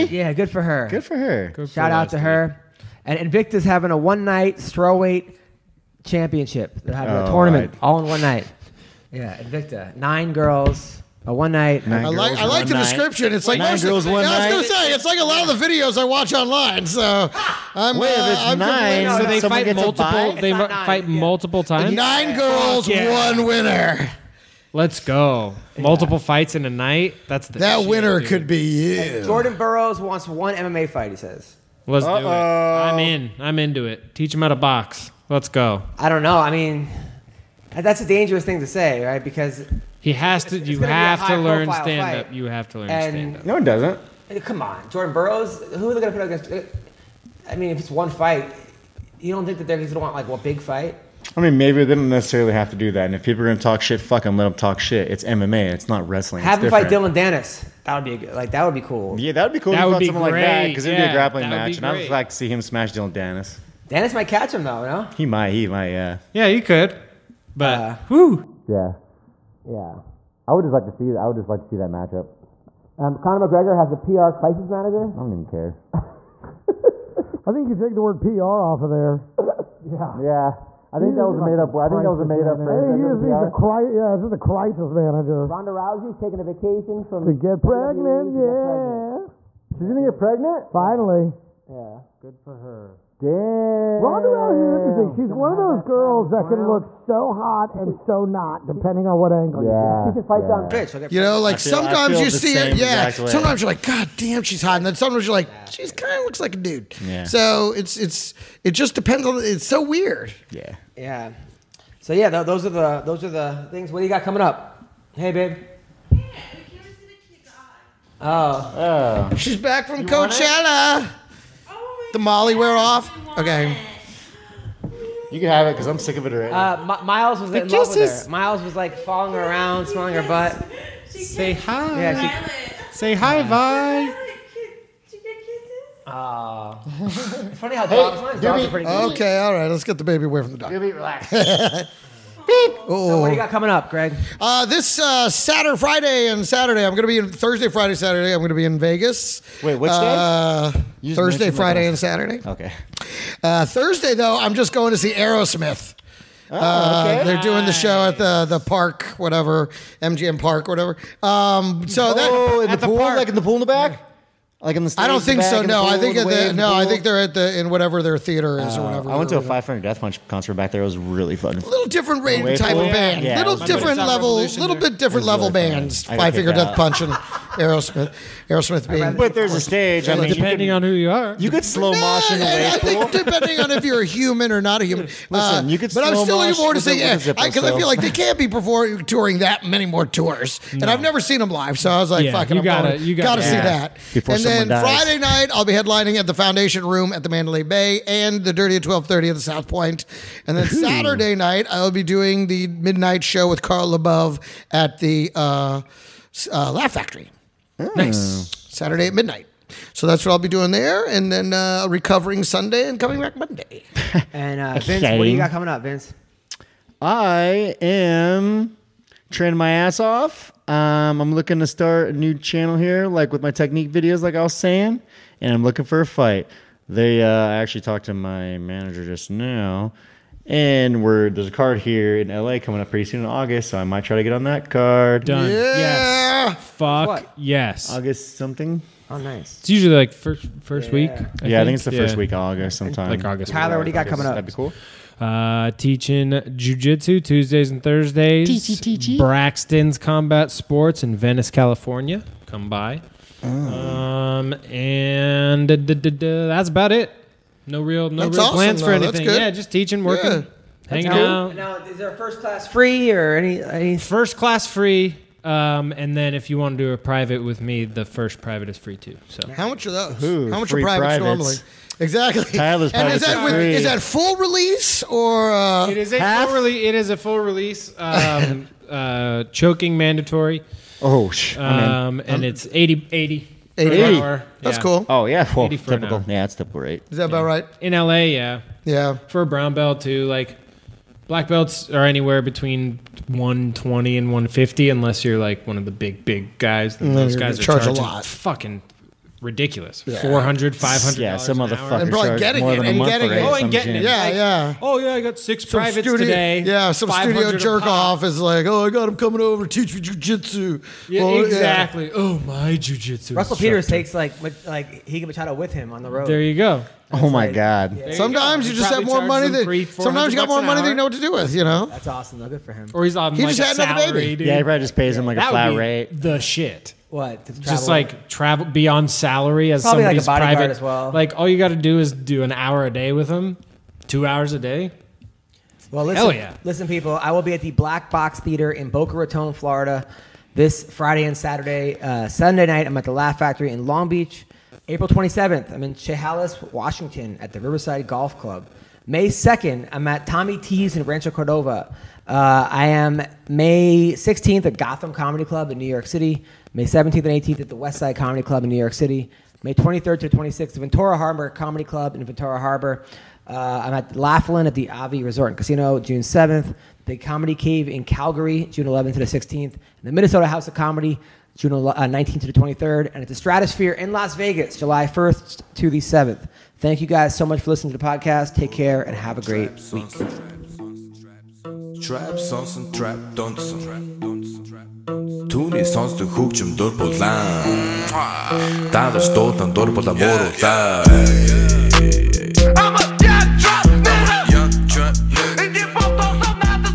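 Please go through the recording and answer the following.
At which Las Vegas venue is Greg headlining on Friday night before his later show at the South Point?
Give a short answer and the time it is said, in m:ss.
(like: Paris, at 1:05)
Foundation Room, at 3:16.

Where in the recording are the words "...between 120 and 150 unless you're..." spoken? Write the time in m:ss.
4:52.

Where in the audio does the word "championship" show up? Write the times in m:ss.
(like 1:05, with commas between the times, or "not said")
0:06.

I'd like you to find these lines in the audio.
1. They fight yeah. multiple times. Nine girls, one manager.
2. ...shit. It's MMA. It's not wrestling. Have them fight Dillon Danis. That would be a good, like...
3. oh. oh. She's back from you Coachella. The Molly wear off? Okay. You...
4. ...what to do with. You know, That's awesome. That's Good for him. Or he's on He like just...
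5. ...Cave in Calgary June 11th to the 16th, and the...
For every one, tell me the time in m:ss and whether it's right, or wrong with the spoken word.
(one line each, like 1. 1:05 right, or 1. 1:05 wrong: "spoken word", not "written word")
1. 0:20 wrong: "winner", not "manager"
2. 0:54 right
3. 1:58 right
4. 5:21 right
5. 6:07 right.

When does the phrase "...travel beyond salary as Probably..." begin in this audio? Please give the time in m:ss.
5:28.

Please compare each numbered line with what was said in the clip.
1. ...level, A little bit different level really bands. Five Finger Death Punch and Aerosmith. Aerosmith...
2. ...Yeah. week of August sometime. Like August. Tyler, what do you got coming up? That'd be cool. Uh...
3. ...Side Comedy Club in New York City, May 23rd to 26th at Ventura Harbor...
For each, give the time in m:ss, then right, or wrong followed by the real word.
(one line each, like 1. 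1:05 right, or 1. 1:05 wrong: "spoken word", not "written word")
1. 2:53 right
2. 4:02 right
3. 5:57 right.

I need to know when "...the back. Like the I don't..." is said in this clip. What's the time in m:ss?
2:43.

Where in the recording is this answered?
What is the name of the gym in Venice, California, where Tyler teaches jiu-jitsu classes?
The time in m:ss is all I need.
4:09.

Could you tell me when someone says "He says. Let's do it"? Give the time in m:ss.
0:31.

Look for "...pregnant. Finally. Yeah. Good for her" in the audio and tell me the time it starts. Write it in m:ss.
1:30.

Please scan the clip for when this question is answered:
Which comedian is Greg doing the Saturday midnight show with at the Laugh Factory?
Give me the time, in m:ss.
3:23.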